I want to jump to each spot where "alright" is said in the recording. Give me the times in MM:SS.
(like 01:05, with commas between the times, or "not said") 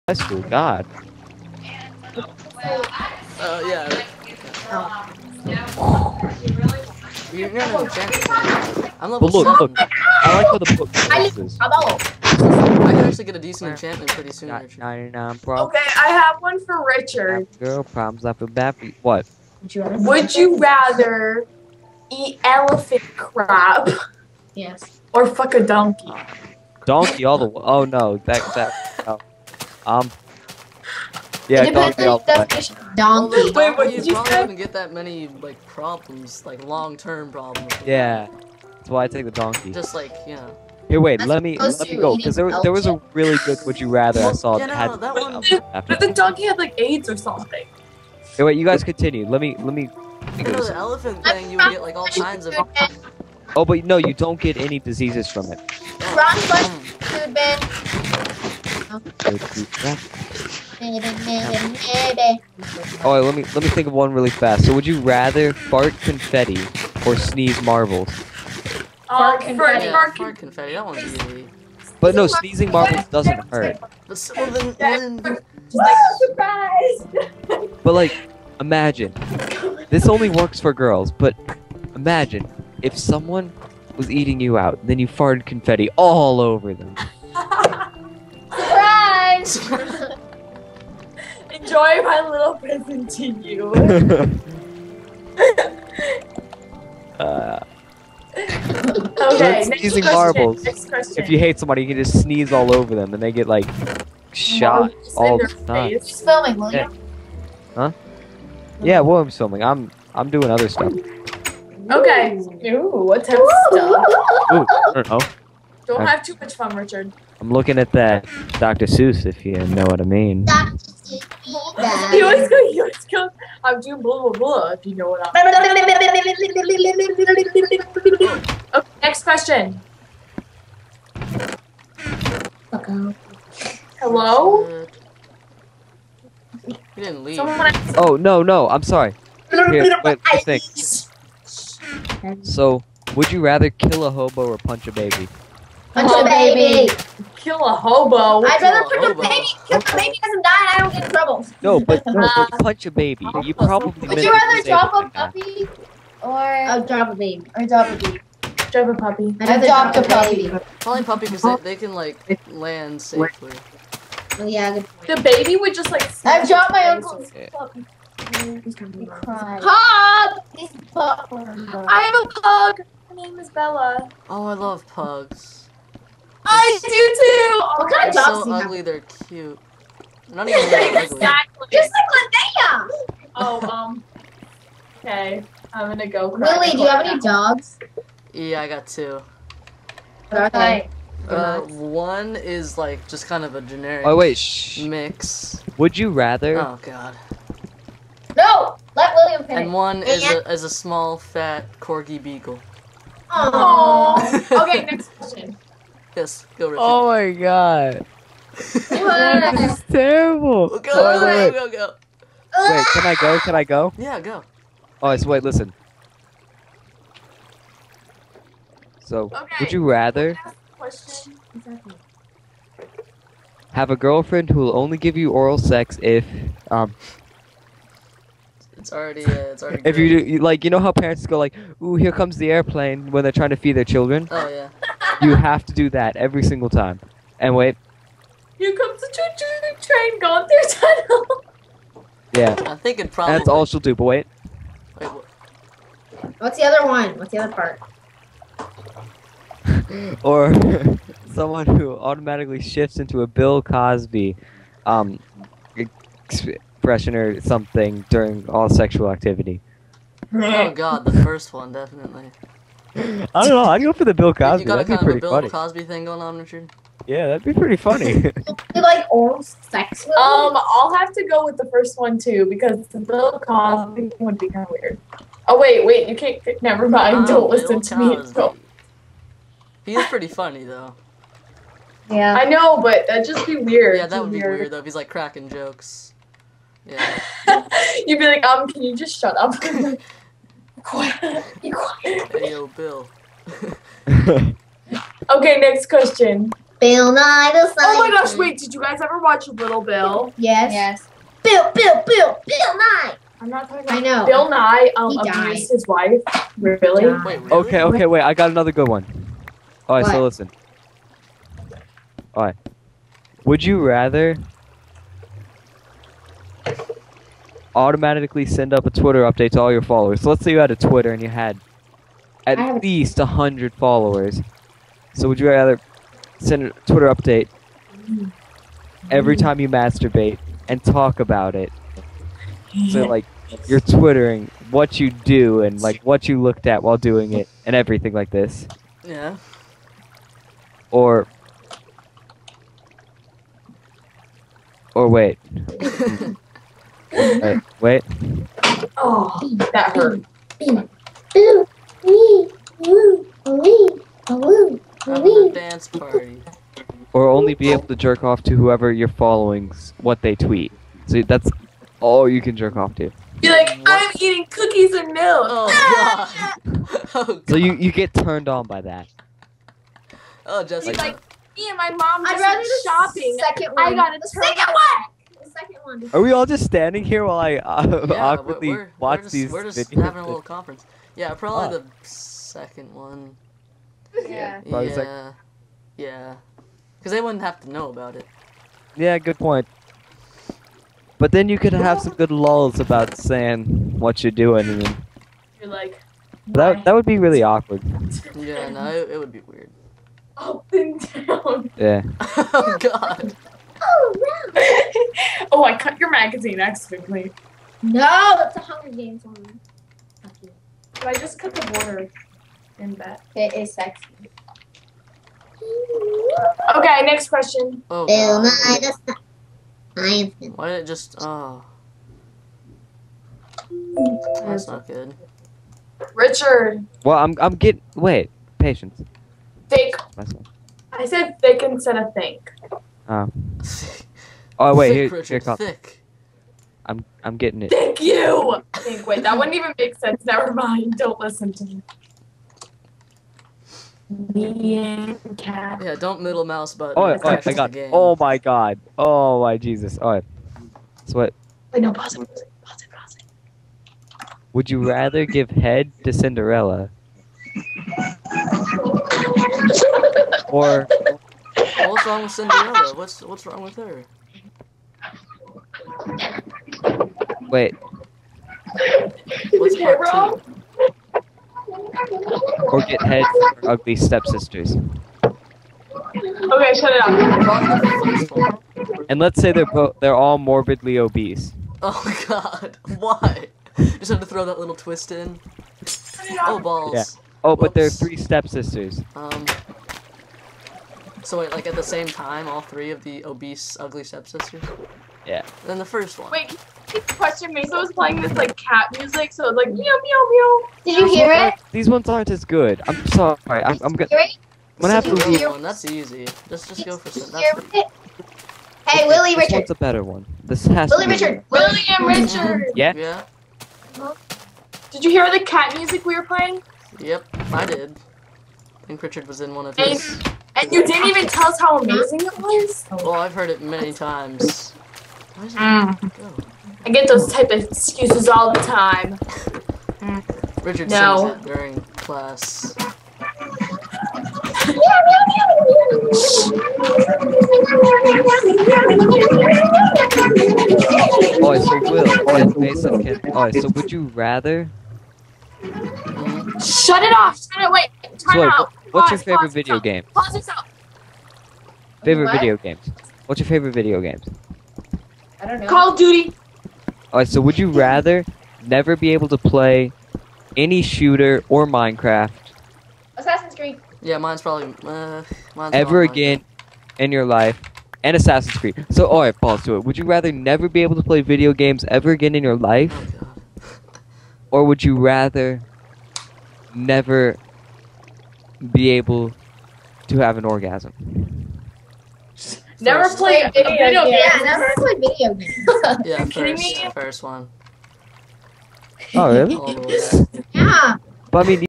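09:17, 09:29.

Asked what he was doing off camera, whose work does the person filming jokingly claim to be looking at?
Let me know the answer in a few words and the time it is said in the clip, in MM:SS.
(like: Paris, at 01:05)
Dr. Seuss, at 01:58.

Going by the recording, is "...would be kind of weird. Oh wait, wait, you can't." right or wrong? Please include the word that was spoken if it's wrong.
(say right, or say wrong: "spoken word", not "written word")
right.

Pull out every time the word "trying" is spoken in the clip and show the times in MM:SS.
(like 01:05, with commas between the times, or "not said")
03:53.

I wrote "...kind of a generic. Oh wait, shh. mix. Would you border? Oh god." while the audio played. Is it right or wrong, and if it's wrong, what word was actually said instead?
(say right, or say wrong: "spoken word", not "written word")
wrong: "rather", not "border".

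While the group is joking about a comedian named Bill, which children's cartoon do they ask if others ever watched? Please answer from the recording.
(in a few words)
Little Bill.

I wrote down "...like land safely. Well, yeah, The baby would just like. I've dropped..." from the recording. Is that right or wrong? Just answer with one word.
right.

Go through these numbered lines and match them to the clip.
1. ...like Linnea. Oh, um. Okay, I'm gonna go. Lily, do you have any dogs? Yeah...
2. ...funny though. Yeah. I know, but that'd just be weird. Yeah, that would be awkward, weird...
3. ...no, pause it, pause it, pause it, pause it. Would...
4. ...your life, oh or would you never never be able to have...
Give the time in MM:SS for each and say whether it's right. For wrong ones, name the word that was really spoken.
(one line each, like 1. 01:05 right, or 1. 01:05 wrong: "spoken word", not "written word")
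1. 03:01 right
2. 04:40 wrong: "weird", not "awkward"
3. 07:31 right
4. 09:32 wrong: "rather", not "never".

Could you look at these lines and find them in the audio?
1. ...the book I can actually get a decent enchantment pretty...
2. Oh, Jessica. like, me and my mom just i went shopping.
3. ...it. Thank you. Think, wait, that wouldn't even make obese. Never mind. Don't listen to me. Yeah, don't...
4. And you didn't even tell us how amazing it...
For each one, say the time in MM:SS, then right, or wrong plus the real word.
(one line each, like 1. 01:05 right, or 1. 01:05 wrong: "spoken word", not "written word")
1. 00:10 right
2. 06:10 right
3. 07:17 wrong: "sense", not "obese"
4. 08:40 right.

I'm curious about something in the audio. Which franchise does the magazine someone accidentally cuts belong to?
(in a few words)
Hunger Games.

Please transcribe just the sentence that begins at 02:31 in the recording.
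No, but, no, but uh, punch a baby.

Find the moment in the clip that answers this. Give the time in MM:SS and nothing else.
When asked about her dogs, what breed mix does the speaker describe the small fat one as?
03:21.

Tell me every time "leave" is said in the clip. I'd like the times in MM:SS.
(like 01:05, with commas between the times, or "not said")
02:17, 08:25.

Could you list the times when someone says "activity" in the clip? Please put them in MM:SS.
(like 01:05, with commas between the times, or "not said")
04:19.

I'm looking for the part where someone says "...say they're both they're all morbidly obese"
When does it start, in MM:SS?
07:59.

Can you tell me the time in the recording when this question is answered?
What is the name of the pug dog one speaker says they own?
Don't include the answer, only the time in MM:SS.
02:53.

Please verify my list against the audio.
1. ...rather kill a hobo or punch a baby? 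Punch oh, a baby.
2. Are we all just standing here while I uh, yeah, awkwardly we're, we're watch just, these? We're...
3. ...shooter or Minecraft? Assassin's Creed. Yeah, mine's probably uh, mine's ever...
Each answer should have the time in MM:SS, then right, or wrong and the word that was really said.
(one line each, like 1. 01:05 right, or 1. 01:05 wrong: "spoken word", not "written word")
1. 02:23 right
2. 06:16 right
3. 09:20 right.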